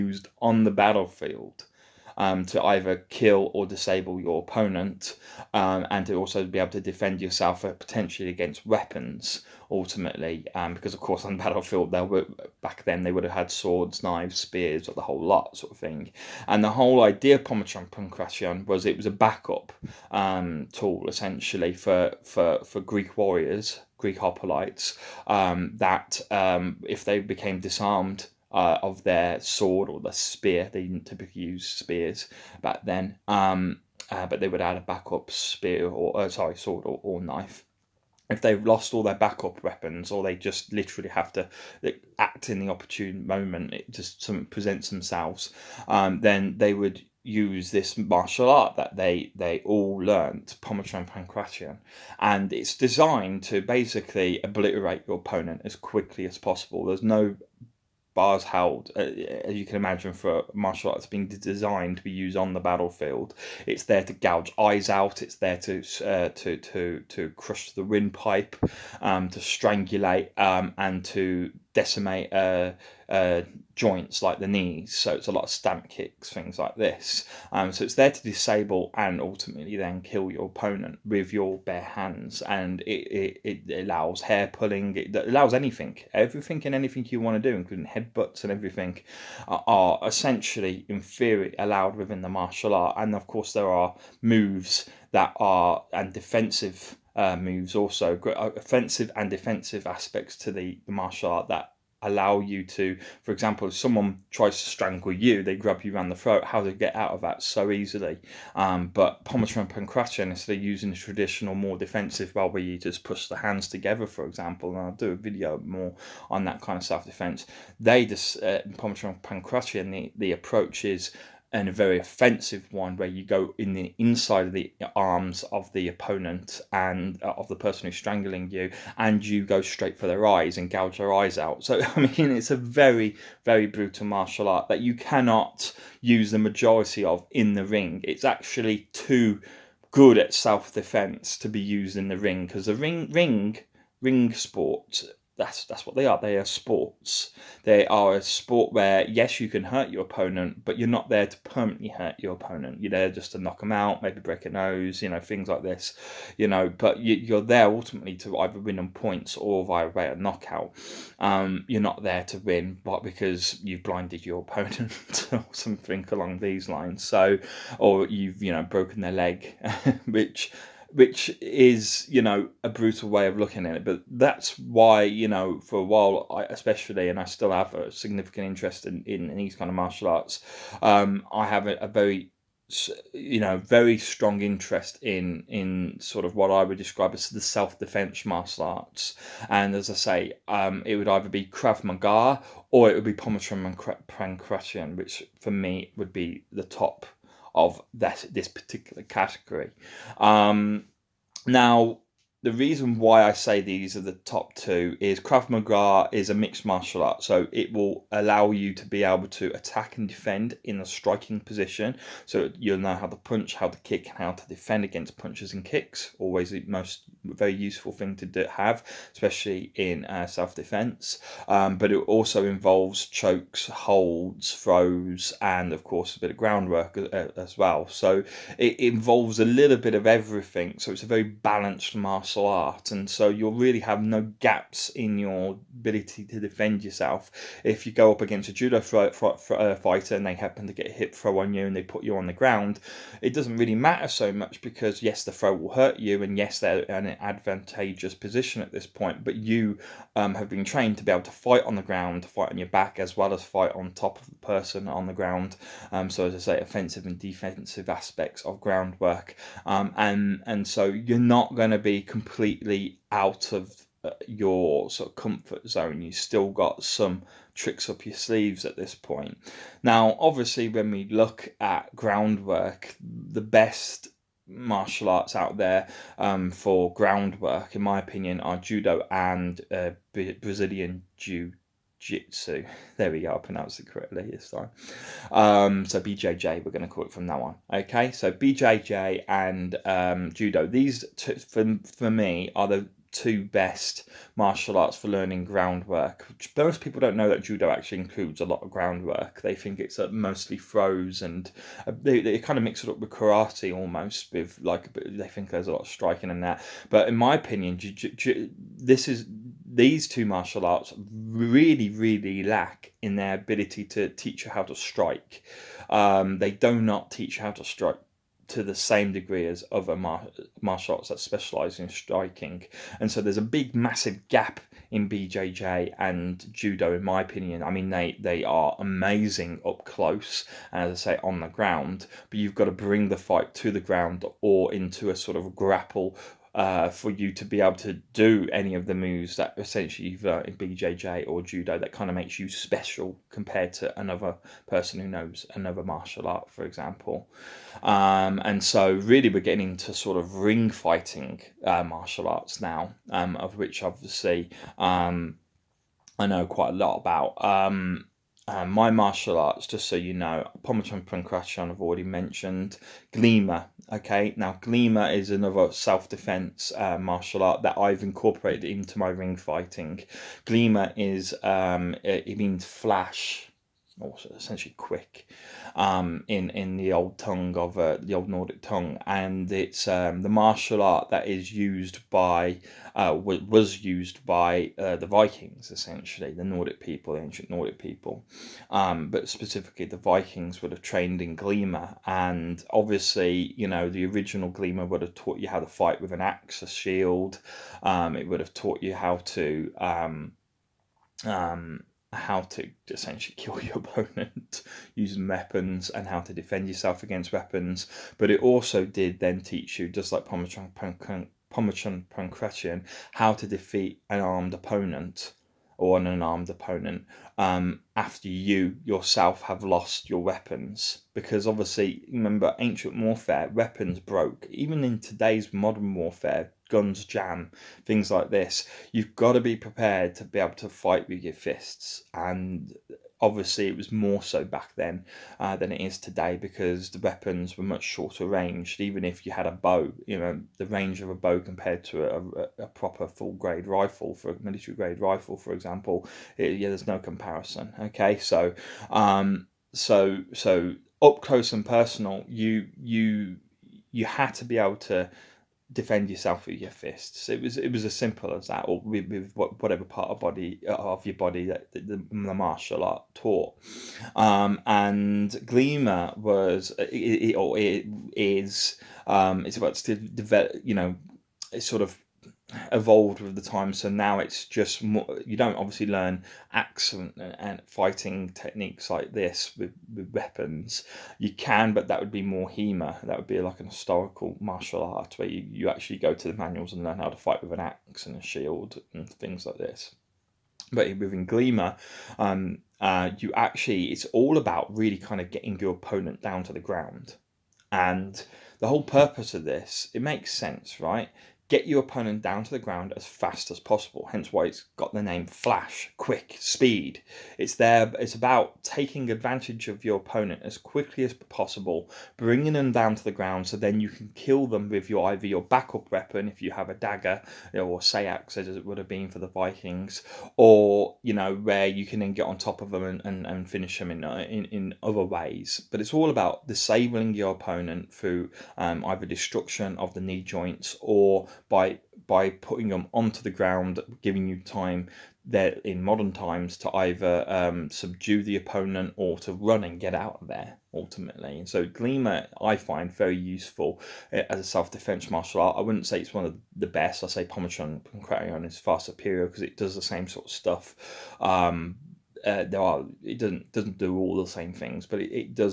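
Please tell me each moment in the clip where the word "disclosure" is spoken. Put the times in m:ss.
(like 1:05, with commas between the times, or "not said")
not said.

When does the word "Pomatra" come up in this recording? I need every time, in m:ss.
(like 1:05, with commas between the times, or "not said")
1:49, 1:58.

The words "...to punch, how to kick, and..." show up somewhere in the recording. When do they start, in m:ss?
3:33.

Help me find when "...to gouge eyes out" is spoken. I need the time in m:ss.
1:04.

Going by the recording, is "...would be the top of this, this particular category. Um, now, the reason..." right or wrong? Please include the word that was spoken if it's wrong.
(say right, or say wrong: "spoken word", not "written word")
right.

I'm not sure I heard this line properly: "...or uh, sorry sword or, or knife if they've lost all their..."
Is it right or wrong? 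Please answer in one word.
right.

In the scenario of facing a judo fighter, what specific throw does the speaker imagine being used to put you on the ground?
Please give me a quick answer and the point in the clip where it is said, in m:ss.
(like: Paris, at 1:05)
hip throw, at 4:00.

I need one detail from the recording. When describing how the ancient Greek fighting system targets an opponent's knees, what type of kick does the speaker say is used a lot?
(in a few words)
stamp kicks.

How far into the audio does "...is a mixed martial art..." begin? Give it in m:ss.
3:26.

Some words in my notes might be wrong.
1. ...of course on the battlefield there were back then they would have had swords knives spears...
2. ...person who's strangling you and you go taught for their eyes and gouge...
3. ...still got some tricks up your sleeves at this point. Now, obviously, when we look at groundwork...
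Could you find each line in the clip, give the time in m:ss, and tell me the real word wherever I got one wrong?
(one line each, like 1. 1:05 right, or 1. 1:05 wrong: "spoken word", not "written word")
1. 0:10 right
2. 2:07 wrong: "straight", not "taught"
3. 4:26 right.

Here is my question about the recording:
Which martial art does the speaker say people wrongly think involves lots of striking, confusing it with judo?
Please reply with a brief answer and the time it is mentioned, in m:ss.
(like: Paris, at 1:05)
karate, at 5:03.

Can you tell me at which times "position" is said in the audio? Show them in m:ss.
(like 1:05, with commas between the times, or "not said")
3:31, 4:08.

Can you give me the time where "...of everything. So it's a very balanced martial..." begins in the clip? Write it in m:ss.
3:49.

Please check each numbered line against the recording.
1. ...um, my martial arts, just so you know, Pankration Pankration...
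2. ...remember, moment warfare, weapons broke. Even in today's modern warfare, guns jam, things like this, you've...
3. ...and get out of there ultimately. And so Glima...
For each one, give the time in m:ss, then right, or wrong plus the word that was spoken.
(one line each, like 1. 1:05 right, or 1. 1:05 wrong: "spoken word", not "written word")
1. 5:58 wrong: "Pammachon", not "Pankration"
2. 7:02 wrong: "ancient", not "moment"
3. 8:59 right.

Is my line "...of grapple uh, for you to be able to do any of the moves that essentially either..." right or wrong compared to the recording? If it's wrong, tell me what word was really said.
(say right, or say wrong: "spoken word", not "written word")
right.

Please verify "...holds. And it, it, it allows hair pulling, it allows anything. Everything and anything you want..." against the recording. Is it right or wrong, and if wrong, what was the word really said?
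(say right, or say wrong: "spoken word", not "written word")
wrong: "hands", not "holds".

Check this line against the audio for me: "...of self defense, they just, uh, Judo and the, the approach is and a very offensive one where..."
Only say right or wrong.
wrong.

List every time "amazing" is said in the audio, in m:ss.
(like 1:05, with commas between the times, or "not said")
5:28.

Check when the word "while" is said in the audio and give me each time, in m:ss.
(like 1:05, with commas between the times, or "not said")
2:55.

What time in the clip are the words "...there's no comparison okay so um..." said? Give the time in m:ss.
7:26.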